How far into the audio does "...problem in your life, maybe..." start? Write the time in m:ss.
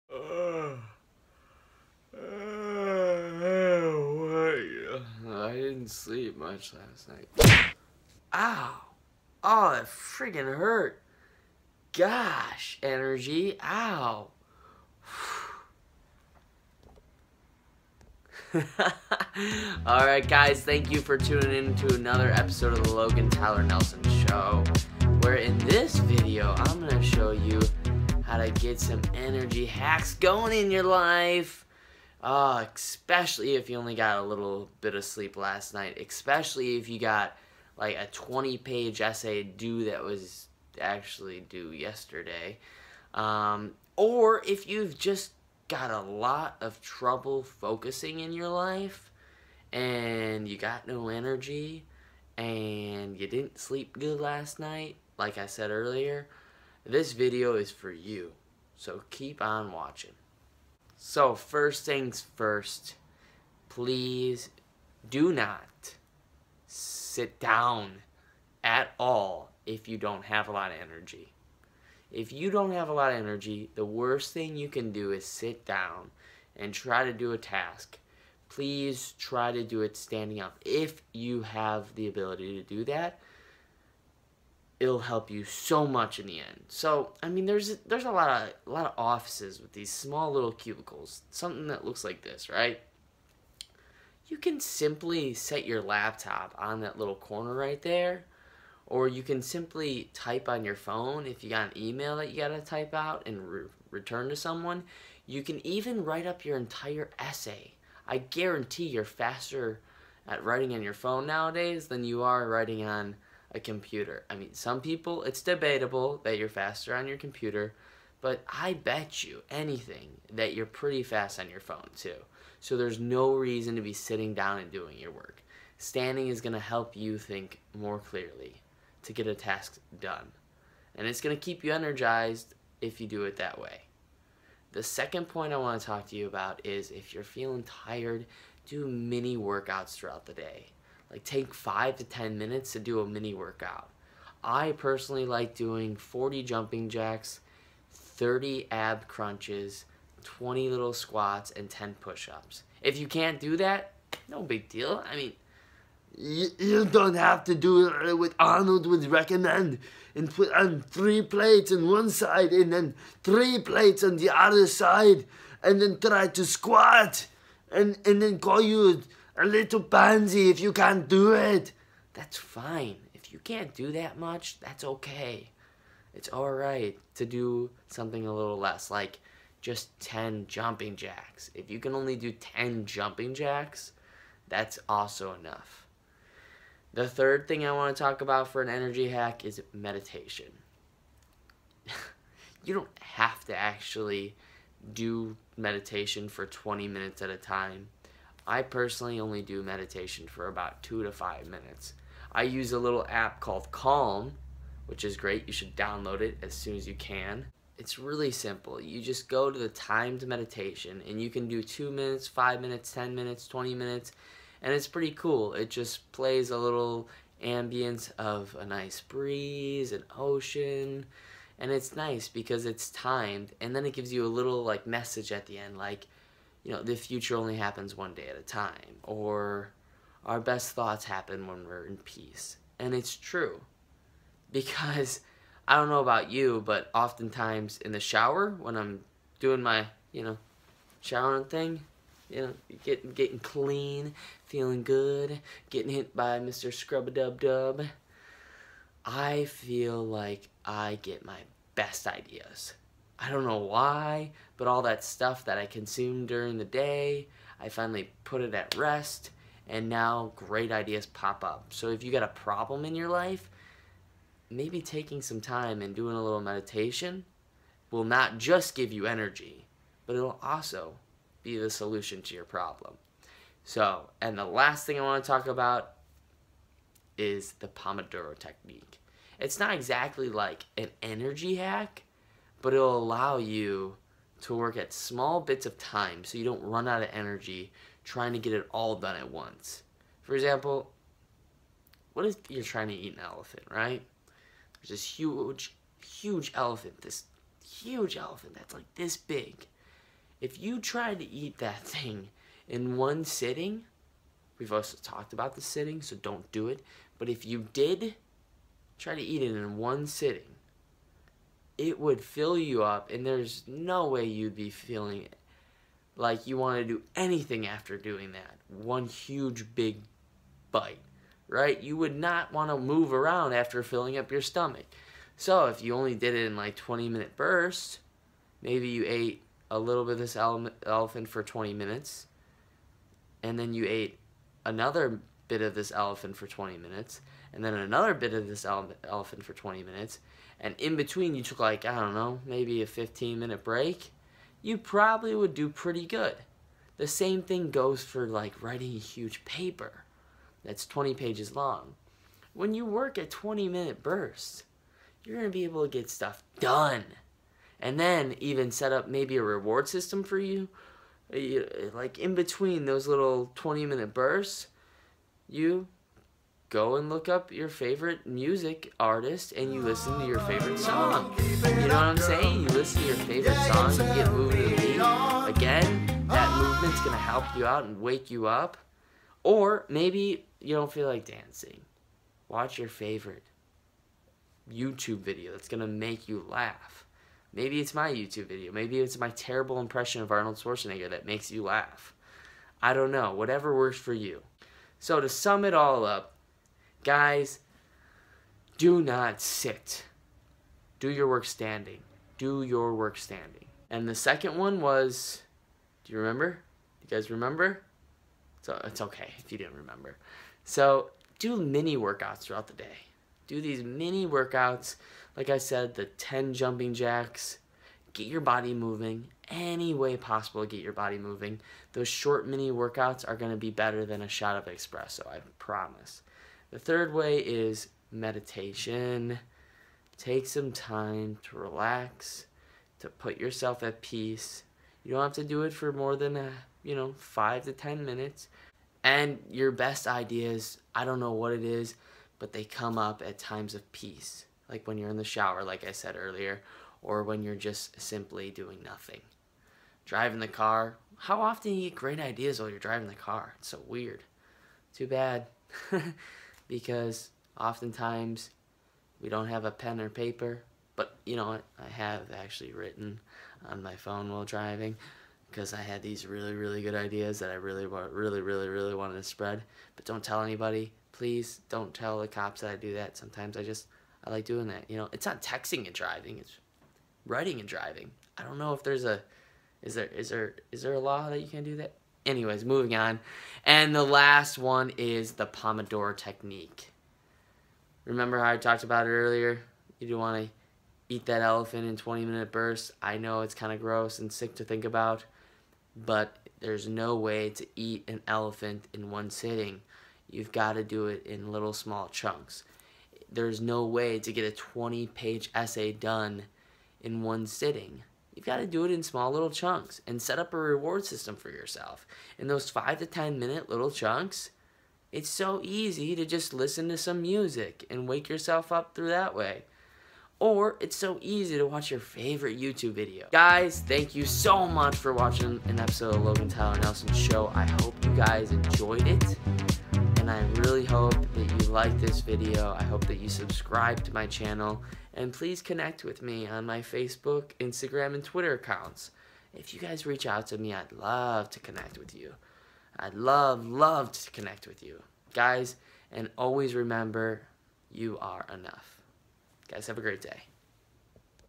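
4:22.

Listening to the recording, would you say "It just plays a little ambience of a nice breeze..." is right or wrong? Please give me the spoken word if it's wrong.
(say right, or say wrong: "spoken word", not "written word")
right.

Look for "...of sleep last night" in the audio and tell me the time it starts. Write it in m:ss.
0:34.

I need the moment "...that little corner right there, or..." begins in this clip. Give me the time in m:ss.
1:36.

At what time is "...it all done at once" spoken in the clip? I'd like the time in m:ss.
4:48.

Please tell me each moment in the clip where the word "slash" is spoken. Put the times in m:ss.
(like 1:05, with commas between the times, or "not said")
not said.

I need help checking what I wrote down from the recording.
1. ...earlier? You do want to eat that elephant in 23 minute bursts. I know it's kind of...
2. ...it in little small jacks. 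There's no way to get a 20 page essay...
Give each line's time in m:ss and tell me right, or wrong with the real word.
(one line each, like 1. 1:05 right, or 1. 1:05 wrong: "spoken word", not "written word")
1. 8:09 wrong: "20", not "23"
2. 8:21 wrong: "chunks", not "jacks".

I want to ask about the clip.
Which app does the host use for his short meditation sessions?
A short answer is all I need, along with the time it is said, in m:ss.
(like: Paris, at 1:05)
Calm, at 3:23.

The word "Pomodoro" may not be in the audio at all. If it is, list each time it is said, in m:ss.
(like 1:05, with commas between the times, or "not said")
4:37, 8:05.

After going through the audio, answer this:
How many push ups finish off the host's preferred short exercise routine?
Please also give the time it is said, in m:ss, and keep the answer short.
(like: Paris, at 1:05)
10, at 2:31.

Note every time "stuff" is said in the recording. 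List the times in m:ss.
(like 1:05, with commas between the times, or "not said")
4:15, 5:56.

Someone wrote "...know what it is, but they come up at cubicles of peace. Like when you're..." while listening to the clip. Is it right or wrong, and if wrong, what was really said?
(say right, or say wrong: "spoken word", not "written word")
wrong: "times", not "cubicles".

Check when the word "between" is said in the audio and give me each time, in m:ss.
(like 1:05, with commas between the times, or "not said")
5:40, 6:02.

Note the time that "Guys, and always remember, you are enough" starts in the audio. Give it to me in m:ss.
9:05.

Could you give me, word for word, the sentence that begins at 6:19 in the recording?
Or maybe you don't feel like dancing.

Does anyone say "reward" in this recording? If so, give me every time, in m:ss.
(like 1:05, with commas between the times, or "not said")
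5:59, 8:30.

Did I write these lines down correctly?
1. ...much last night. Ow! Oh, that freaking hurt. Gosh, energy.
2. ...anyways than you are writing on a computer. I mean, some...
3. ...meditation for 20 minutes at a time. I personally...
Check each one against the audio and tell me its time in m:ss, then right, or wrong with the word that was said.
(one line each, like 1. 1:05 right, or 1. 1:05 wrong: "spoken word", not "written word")
1. 0:06 right
2. 1:51 wrong: "nowadays", not "anyways"
3. 3:15 right.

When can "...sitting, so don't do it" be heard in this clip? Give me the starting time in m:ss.
5:05.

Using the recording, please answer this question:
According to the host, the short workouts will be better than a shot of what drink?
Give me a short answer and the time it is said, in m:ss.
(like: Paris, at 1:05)
espresso, at 7:04.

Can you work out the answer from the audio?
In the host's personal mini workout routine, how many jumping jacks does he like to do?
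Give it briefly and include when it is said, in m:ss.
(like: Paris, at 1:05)
40, at 2:25.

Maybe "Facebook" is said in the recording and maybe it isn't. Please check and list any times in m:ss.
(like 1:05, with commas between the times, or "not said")
8:56.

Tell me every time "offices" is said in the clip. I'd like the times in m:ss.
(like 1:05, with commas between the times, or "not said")
1:28.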